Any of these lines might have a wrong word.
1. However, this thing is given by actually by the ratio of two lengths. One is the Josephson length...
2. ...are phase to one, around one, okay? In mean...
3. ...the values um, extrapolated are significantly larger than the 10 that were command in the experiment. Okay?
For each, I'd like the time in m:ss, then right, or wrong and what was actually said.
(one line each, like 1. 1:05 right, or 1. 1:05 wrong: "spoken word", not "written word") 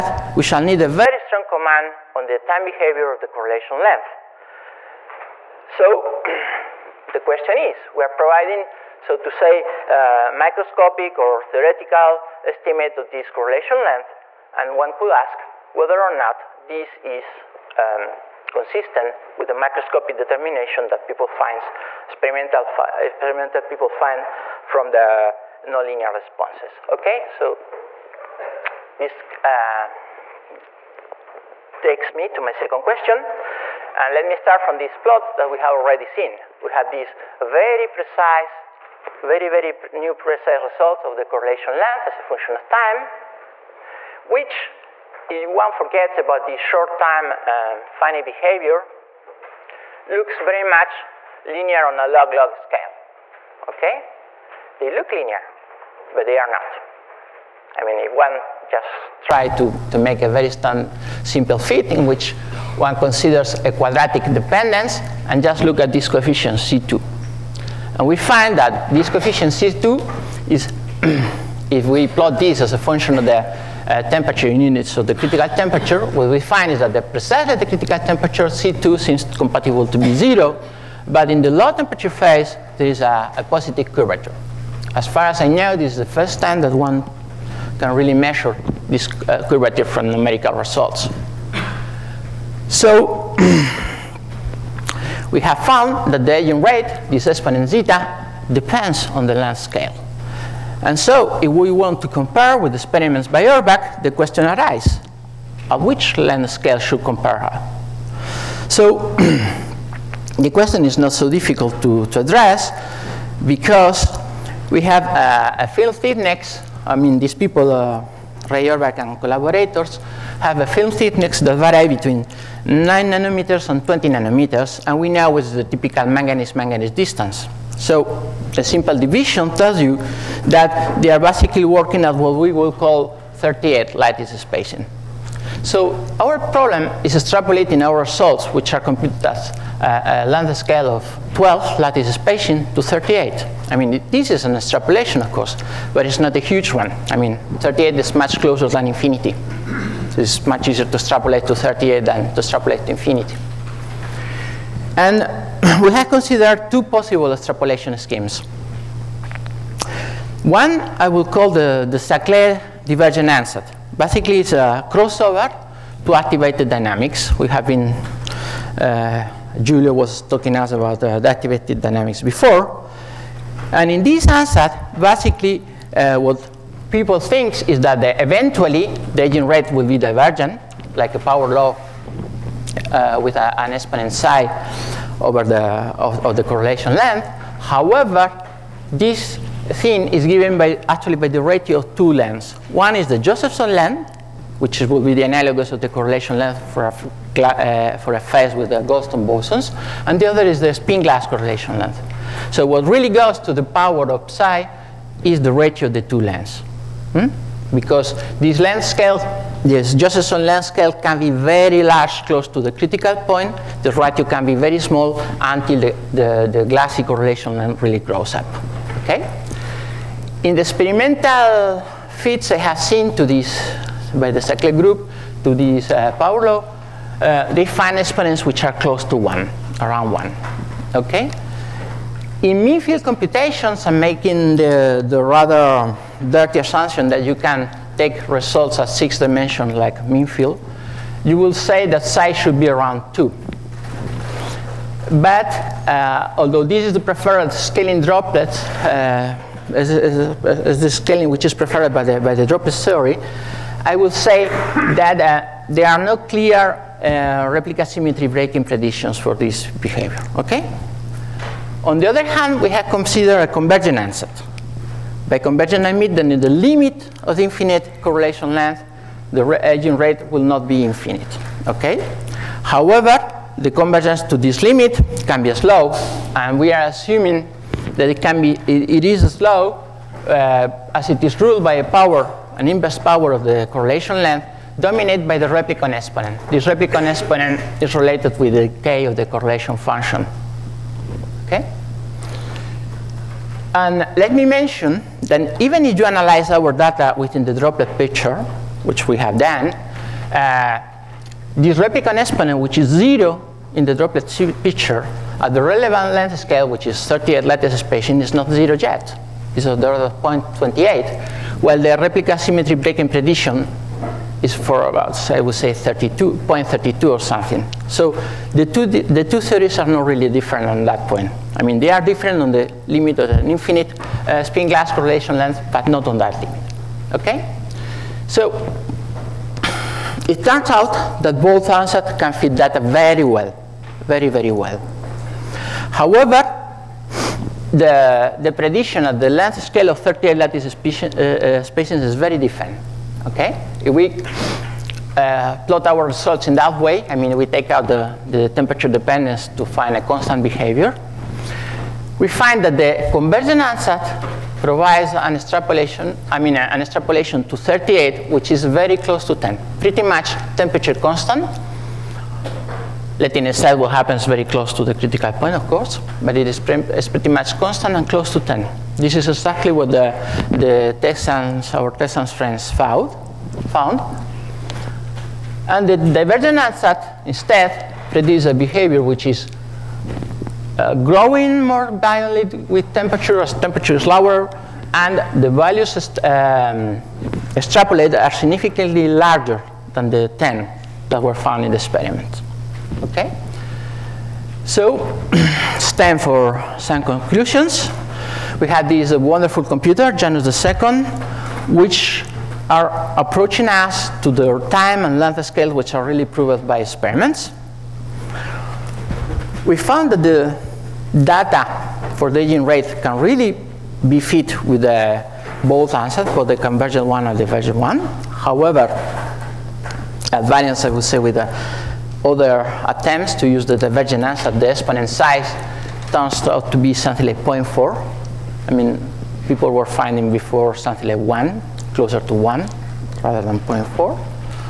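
1. 3:07 right
2. 3:48 wrong: "close", not "phase"
3. 6:25 wrong: "found", not "command".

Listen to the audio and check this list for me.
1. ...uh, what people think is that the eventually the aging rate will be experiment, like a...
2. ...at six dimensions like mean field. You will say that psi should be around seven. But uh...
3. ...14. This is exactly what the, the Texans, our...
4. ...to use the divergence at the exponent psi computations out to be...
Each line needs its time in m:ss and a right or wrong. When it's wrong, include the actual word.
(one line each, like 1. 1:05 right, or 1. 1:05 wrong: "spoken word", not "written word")
1. 2:55 wrong: "divergent", not "experiment"
2. 3:58 wrong: "two", not "seven"
3. 6:08 wrong: "10", not "14"
4. 7:03 wrong: "turns", not "computations".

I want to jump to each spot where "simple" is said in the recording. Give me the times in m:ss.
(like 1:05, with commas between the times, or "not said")
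1:01, 2:08.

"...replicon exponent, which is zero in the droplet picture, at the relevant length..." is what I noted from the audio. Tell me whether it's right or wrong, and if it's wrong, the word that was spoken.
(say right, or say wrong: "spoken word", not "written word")
right.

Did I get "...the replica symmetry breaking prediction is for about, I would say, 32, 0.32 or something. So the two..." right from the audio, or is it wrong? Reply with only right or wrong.
right.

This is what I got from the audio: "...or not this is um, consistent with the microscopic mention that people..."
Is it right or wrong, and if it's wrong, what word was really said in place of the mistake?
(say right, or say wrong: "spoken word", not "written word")
wrong: "determination", not "mention".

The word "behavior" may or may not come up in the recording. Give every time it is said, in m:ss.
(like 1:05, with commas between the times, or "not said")
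0:02, 0:48, 4:19, 5:50, 6:18.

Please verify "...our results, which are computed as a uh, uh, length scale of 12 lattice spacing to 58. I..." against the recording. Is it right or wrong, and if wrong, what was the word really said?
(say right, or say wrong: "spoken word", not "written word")
wrong: "38", not "58".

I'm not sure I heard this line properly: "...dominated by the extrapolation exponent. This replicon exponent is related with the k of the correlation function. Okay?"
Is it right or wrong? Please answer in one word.
wrong.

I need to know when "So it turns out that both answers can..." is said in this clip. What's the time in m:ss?
5:28.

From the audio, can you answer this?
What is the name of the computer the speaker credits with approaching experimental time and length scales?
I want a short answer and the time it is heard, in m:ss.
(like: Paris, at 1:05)
Janus II, at 6:40.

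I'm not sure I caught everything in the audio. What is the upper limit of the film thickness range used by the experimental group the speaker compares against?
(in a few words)
20 nanometers.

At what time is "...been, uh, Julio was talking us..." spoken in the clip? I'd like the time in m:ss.
2:47.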